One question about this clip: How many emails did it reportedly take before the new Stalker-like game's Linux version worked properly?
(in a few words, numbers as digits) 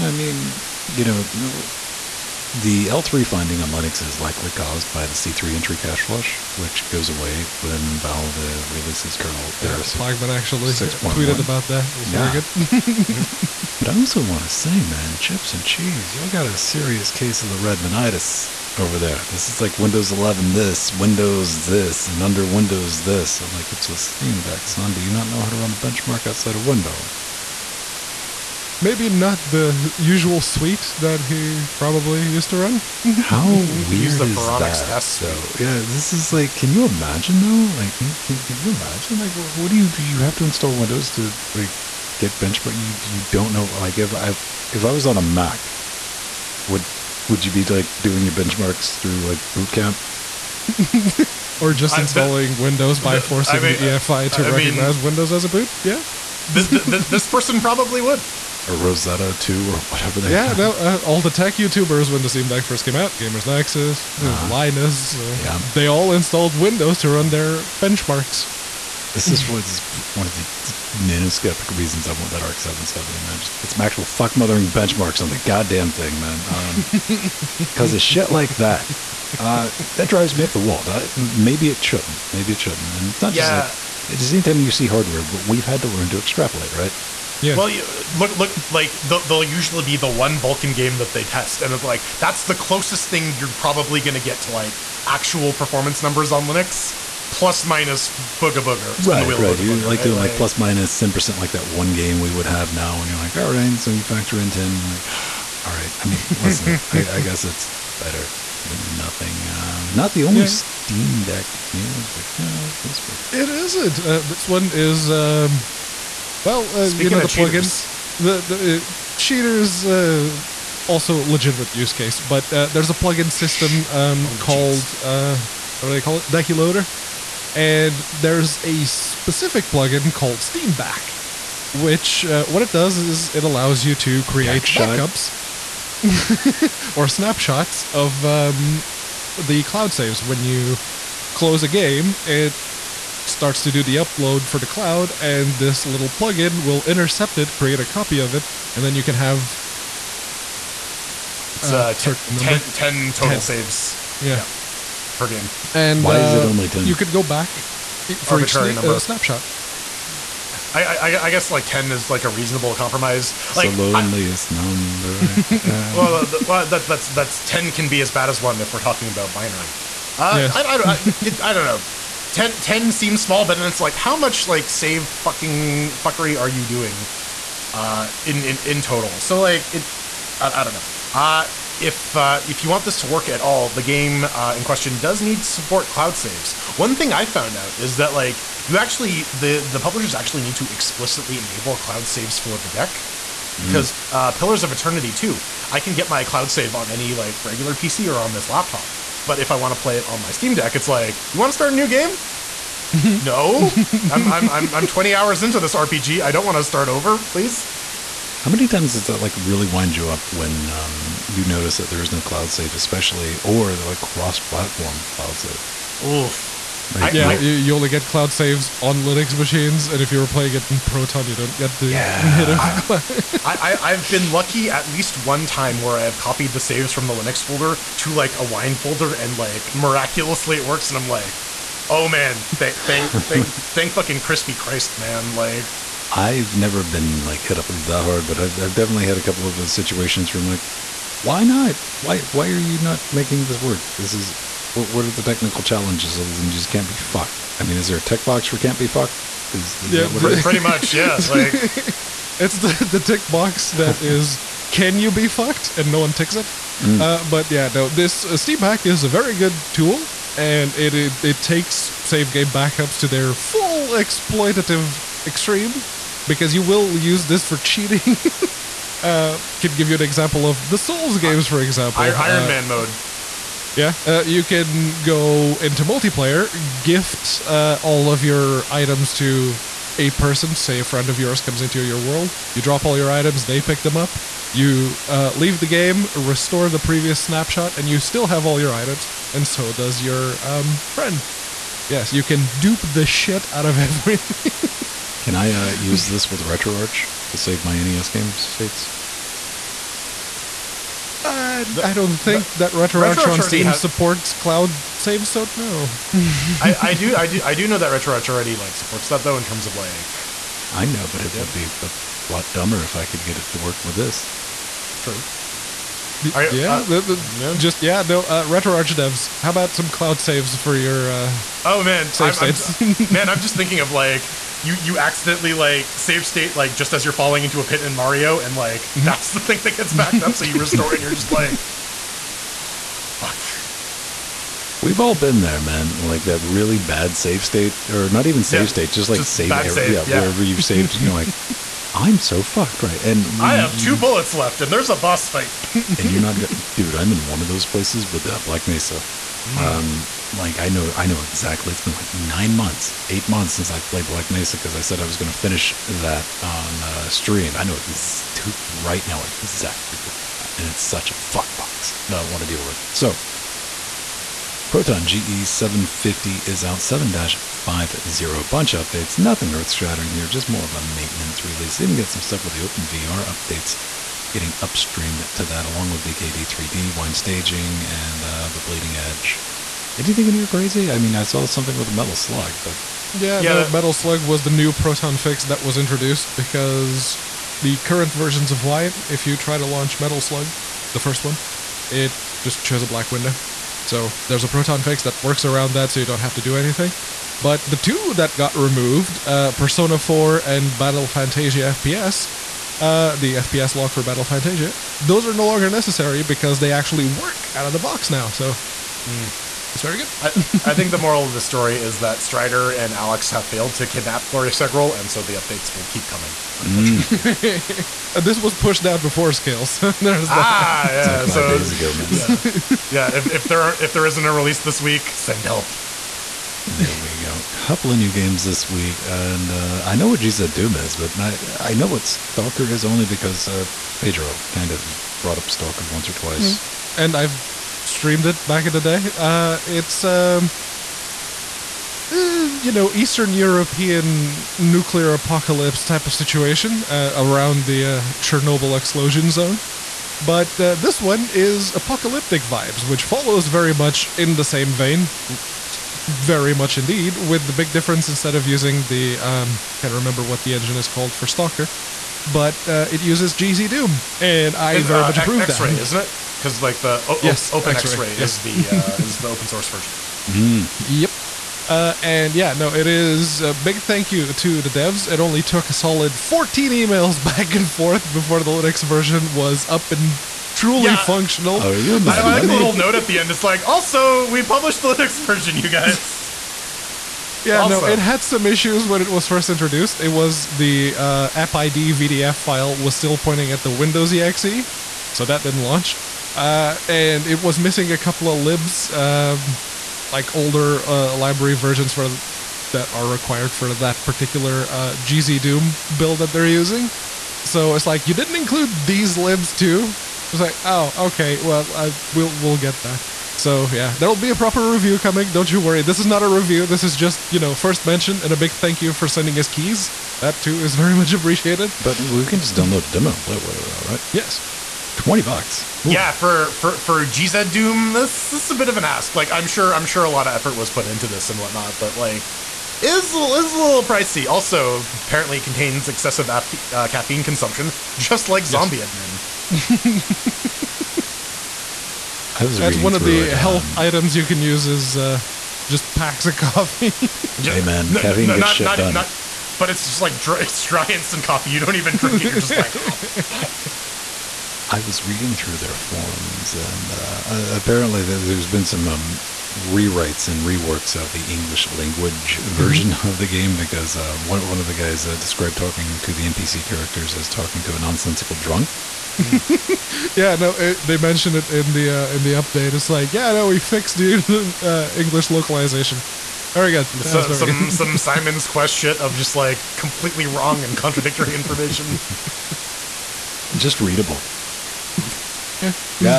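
14.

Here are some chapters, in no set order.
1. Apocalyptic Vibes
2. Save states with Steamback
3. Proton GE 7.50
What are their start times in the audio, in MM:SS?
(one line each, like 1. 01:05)
1. 07:35
2. 02:08
3. 06:08.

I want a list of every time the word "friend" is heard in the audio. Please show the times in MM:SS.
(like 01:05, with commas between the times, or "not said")
04:40, 04:50.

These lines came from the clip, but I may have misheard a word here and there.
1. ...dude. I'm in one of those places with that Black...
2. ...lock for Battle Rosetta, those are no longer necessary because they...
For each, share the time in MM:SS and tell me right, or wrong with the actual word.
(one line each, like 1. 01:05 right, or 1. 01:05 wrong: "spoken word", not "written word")
1. 05:46 right
2. 06:43 wrong: "Fantasia", not "Rosetta".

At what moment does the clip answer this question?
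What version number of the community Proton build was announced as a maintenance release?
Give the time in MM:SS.
06:06.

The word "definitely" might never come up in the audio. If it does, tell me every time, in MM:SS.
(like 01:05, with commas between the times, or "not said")
03:58.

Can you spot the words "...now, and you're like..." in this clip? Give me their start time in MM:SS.
01:42.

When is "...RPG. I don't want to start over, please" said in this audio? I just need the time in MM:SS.
03:25.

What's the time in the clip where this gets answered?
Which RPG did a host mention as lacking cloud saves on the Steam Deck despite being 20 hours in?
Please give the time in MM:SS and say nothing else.
03:14.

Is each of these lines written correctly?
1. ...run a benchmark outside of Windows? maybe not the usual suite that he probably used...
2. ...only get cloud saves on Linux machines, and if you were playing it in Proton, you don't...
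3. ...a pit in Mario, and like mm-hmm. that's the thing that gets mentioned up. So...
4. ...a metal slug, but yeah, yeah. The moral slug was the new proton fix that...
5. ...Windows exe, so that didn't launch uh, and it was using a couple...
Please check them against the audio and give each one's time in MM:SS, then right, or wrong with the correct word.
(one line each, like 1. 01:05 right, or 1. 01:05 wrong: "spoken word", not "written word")
1. 00:25 right
2. 03:37 right
3. 05:27 wrong: "backed", not "mentioned"
4. 06:21 wrong: "metal", not "moral"
5. 08:13 wrong: "missing", not "using".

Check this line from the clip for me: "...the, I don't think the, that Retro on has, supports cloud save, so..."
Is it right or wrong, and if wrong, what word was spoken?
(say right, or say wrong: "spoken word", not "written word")
right.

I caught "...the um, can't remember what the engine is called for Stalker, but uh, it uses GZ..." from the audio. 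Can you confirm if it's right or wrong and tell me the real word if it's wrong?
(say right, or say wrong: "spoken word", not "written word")
right.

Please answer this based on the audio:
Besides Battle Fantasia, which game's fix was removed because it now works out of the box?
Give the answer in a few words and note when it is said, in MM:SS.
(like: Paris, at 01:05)
Persona 4, at 06:39.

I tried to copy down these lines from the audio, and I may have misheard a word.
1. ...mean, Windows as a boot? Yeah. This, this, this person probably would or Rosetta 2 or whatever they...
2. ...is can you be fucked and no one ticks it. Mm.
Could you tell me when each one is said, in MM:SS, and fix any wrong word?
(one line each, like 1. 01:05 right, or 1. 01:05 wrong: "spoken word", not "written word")
1. 00:54 right
2. 04:14 right.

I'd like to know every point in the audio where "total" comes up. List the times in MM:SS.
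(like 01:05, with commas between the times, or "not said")
02:33, 02:58.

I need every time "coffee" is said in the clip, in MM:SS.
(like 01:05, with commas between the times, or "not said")
09:06, 09:11.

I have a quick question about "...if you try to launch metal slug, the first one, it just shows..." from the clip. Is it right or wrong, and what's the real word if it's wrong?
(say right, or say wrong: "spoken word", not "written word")
right.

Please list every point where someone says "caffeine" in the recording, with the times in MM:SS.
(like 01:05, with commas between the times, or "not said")
08:56, 09:08.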